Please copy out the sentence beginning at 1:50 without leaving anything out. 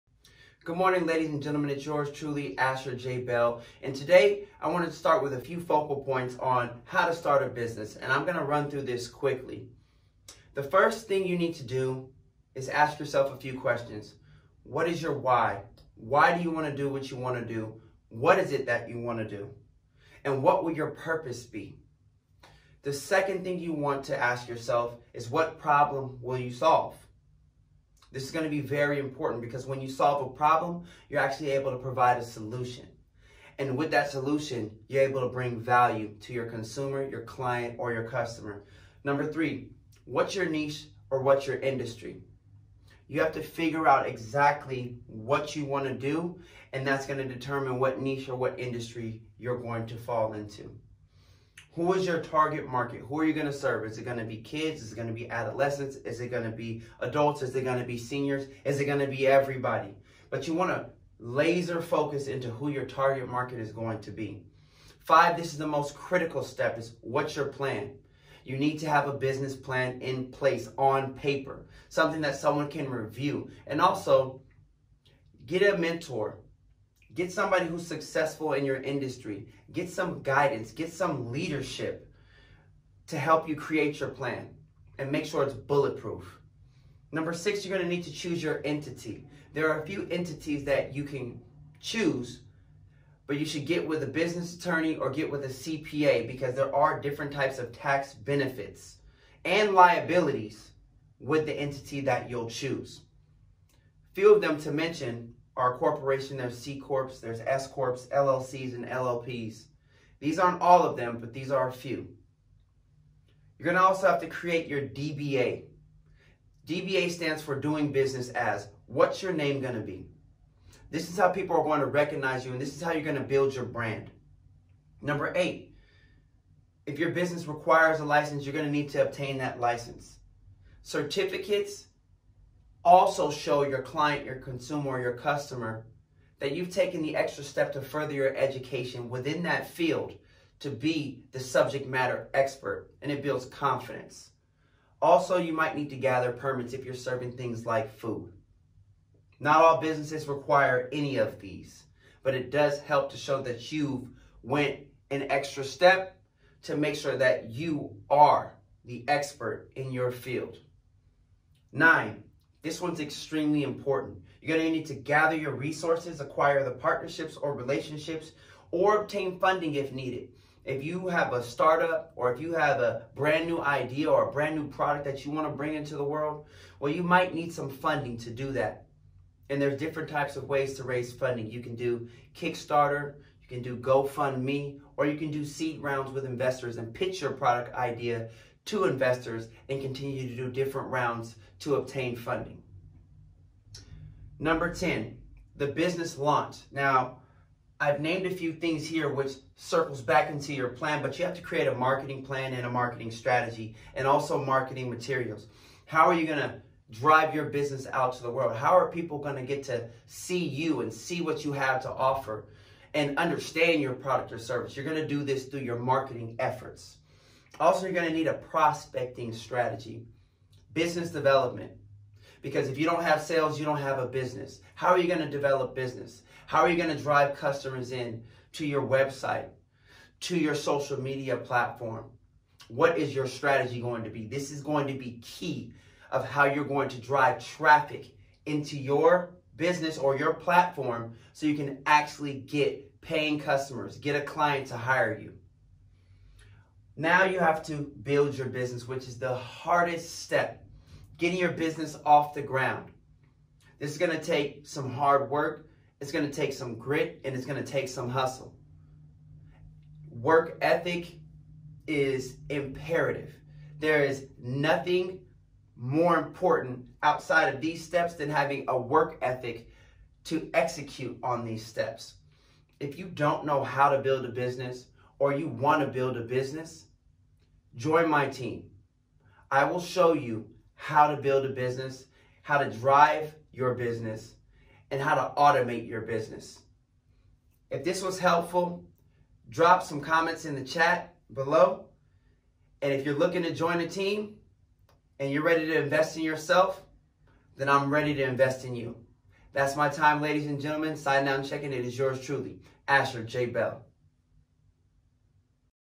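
These aren't all of them, but these are a few.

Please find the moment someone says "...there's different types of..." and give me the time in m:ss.
2:59.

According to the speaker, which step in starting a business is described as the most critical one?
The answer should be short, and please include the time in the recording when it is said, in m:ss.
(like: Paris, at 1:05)
what's your plan, at 1:07.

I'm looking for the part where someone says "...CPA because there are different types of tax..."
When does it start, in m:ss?
1:35.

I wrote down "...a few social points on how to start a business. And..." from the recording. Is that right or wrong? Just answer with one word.
wrong.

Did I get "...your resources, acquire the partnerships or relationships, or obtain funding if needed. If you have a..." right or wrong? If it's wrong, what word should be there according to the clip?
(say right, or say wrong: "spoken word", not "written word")
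right.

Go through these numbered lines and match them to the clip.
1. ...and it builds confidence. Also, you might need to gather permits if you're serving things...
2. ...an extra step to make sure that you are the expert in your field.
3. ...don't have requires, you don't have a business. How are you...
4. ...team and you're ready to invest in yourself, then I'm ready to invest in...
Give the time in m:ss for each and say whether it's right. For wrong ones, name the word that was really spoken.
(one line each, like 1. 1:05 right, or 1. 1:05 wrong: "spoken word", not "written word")
1. 2:23 right
2. 2:35 right
3. 3:42 wrong: "sales", not "requires"
4. 4:53 right.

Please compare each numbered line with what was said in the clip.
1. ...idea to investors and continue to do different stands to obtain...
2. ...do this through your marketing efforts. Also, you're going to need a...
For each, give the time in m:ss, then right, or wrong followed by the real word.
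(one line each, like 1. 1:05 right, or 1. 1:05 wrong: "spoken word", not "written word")
1. 3:07 wrong: "rounds", not "stands"
2. 3:35 right.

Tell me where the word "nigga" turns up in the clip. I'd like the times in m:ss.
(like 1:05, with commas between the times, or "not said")
not said.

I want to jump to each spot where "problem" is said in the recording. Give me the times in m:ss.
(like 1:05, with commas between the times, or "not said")
0:25, 0:30.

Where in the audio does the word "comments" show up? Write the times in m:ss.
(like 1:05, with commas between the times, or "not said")
4:50.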